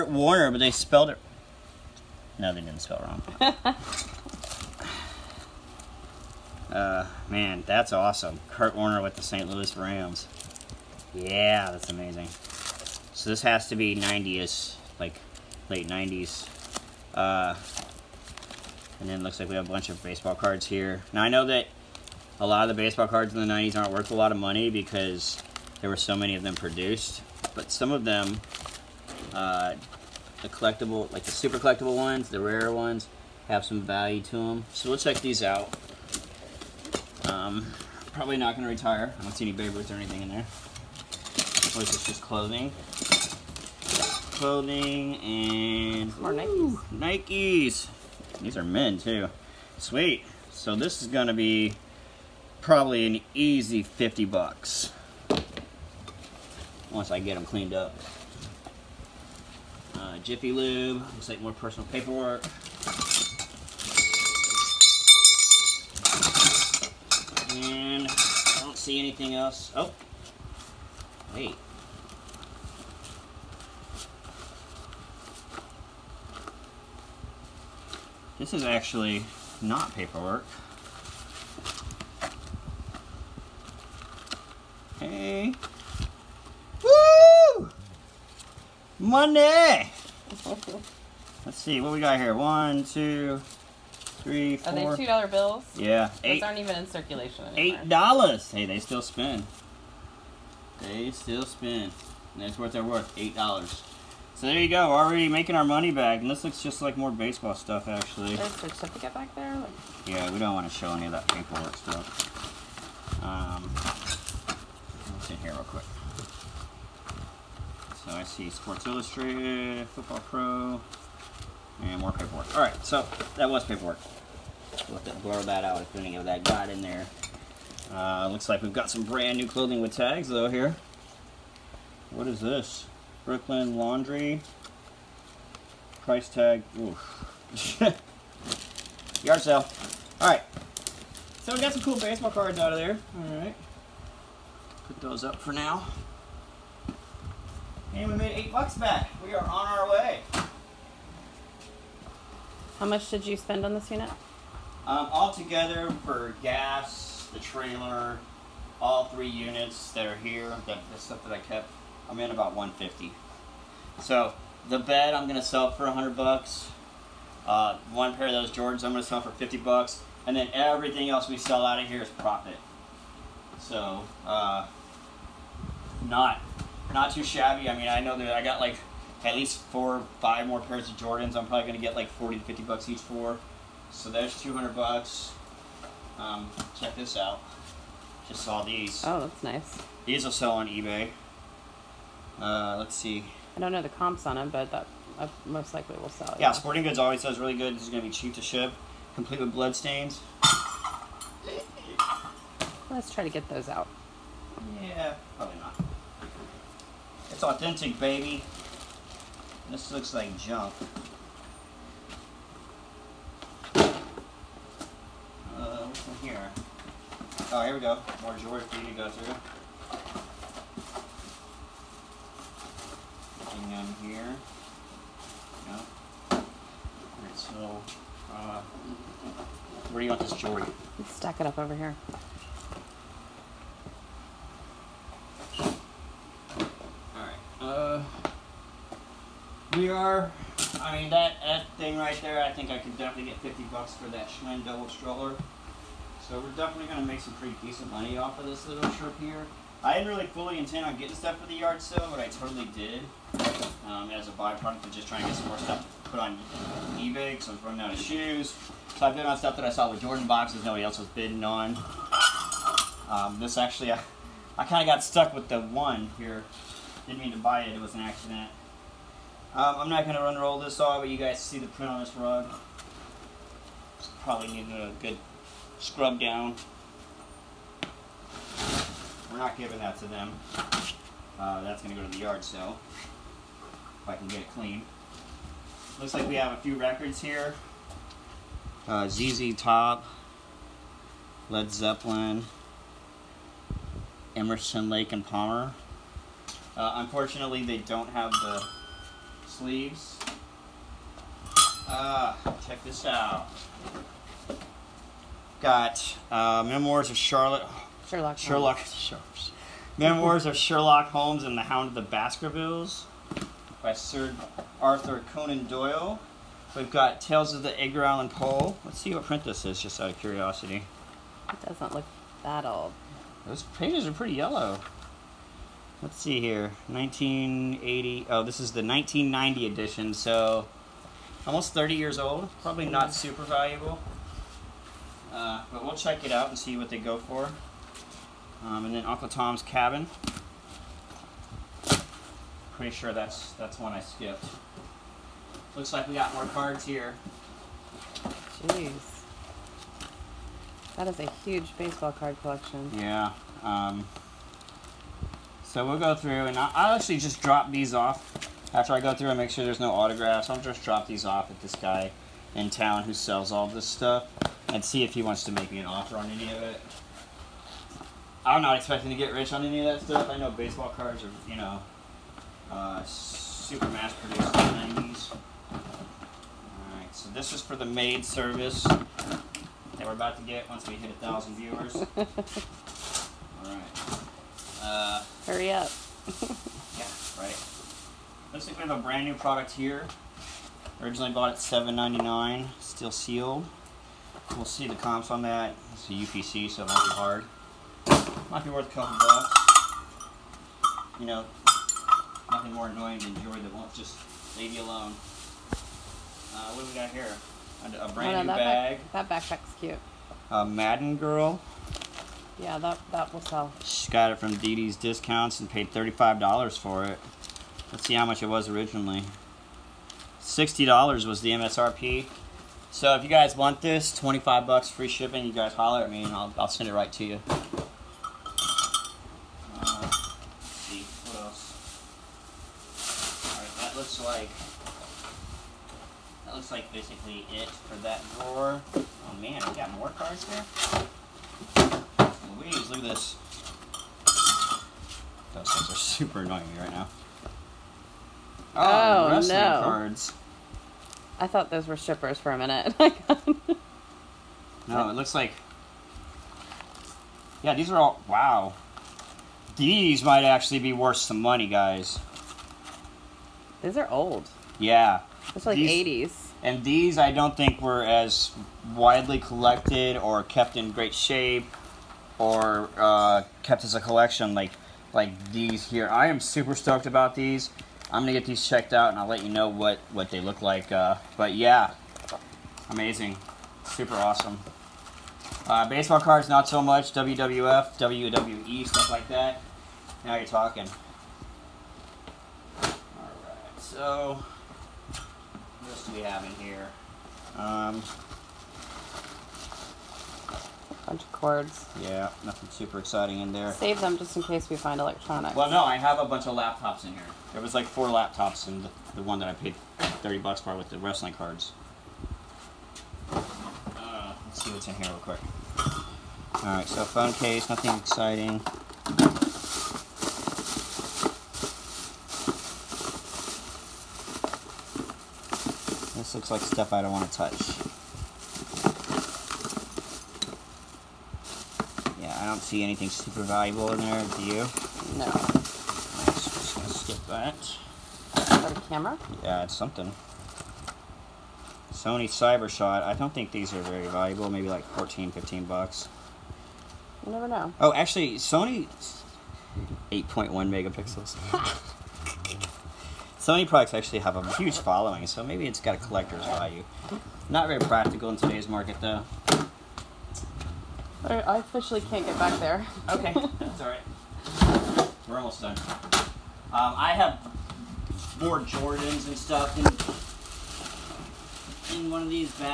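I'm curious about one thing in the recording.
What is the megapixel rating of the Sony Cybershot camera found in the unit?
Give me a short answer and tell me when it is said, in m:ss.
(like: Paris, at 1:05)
8.1 megapixels, at 9:10.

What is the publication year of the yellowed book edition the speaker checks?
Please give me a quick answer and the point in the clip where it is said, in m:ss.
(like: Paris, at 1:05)
1990, at 5:28.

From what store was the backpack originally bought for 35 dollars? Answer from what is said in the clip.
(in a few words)
Dee Dee's Discounts.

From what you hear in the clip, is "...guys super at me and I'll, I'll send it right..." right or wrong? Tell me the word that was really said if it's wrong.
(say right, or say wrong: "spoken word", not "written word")
wrong: "holler", not "super".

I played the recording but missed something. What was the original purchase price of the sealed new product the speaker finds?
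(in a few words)
$7.99.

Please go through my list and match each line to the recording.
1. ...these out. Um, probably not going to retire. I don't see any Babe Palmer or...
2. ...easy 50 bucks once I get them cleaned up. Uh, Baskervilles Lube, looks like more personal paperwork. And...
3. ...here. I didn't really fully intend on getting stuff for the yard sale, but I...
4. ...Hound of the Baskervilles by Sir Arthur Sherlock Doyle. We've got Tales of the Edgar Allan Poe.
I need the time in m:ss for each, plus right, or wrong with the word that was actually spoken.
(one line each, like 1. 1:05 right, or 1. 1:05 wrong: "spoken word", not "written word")
1. 0:35 wrong: "Ruth", not "Palmer"
2. 0:53 wrong: "Jiffy", not "Baskervilles"
3. 4:09 right
4. 5:11 wrong: "Conan", not "Sherlock".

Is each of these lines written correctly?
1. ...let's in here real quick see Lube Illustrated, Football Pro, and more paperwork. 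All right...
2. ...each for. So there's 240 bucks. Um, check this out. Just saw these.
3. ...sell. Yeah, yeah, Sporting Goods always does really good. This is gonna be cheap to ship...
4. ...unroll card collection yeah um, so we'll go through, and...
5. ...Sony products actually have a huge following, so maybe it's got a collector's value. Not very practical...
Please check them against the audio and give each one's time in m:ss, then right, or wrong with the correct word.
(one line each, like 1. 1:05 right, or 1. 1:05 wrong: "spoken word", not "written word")
1. 1:55 wrong: "Sports", not "Lube"
2. 3:02 wrong: "200", not "240"
3. 3:16 right
4. 5:51 wrong: "baseball", not "unroll"
5. 9:13 right.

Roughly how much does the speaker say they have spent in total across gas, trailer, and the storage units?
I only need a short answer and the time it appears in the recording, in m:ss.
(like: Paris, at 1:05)
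150, at 2:42.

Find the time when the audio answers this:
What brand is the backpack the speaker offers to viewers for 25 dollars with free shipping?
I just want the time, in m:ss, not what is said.
6:50.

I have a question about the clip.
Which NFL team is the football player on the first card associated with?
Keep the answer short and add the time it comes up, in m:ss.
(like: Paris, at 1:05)
St. Louis Rams, at 0:09.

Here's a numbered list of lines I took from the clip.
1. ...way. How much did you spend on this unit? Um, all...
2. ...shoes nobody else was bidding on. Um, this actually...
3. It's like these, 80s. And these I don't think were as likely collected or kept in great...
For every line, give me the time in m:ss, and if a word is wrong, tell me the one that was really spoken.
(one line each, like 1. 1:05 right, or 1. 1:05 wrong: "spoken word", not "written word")
1. 2:29 right
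2. 4:20 wrong: "boxes", not "shoes"
3. 7:45 wrong: "widely", not "likely".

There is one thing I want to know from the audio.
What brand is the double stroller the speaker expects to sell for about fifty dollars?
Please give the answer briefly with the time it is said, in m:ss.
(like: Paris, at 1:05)
Schwinn, at 4:04.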